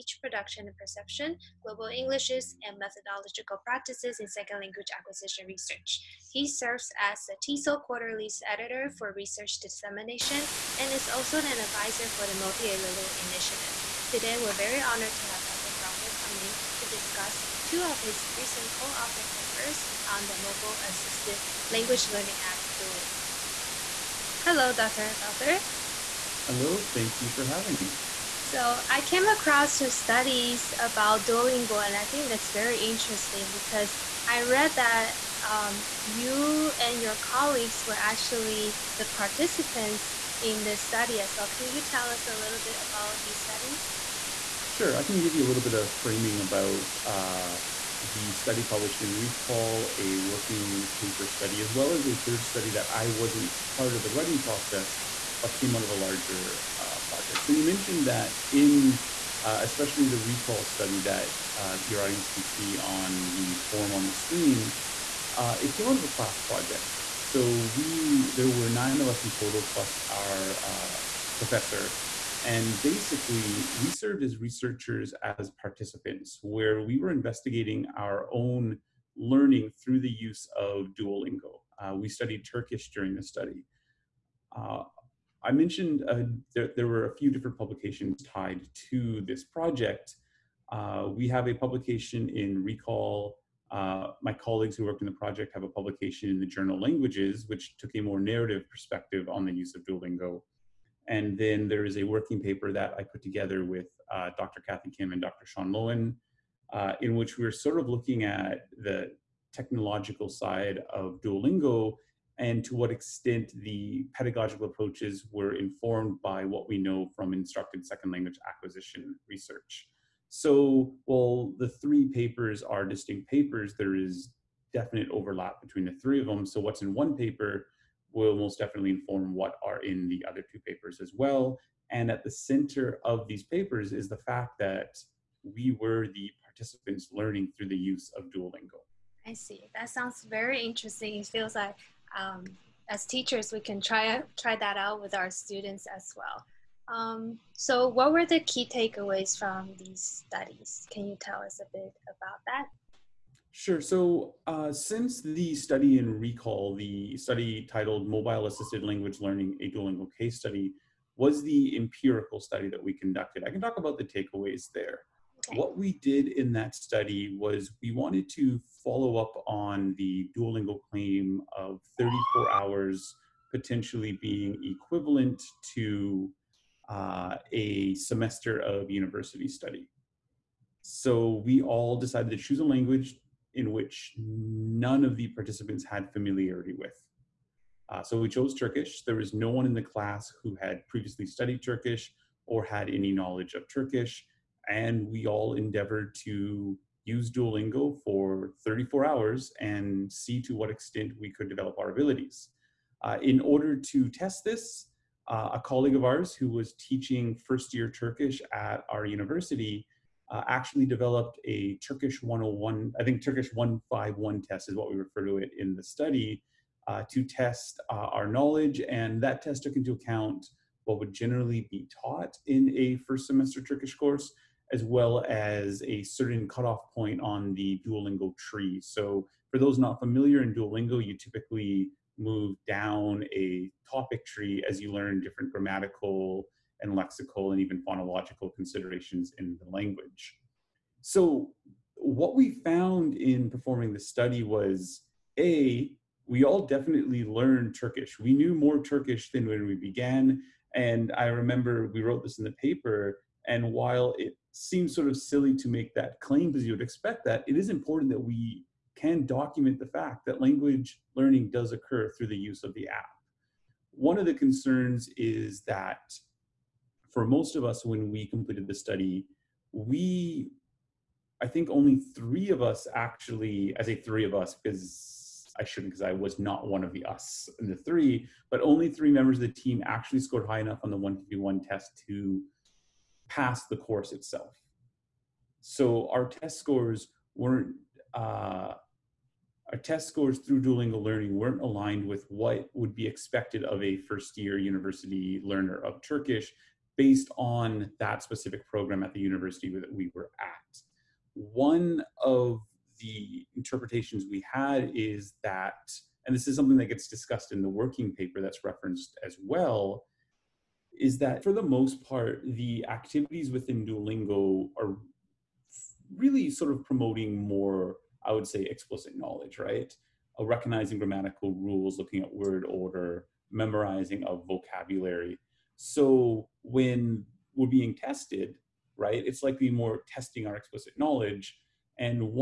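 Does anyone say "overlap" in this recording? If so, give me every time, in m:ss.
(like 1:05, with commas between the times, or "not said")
2:05.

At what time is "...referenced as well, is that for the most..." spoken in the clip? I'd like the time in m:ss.
5:08.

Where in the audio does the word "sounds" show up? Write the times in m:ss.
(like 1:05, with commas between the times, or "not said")
2:19.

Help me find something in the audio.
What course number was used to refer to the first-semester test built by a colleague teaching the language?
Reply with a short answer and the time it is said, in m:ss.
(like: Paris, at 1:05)
151, at 3:33.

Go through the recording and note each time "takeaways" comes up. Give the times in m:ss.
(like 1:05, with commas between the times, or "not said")
2:28, 2:44.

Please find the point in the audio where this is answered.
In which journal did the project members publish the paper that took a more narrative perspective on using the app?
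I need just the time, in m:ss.
1:36.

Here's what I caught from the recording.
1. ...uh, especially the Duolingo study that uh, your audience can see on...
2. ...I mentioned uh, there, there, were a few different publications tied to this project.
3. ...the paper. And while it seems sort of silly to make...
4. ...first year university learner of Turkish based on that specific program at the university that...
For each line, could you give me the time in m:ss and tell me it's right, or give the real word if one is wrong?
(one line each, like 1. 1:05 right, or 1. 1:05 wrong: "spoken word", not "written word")
1. 0:59 wrong: "ReCALL", not "Duolingo"
2. 1:25 right
3. 4:12 right
4. 4:53 right.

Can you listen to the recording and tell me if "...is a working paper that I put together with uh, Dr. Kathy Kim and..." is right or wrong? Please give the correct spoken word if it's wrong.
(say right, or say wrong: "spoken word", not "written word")
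right.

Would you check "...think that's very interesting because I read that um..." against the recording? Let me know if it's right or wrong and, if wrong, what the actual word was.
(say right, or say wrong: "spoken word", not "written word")
right.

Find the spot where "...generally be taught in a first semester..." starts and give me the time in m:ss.
3:41.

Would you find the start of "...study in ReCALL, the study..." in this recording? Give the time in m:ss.
2:35.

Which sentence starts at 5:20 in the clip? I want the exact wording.
Uh, recognizing grammatical rules, looking at word order, memorizing of vocabulary.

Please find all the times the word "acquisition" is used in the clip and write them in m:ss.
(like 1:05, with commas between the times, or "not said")
0:04, 1:58.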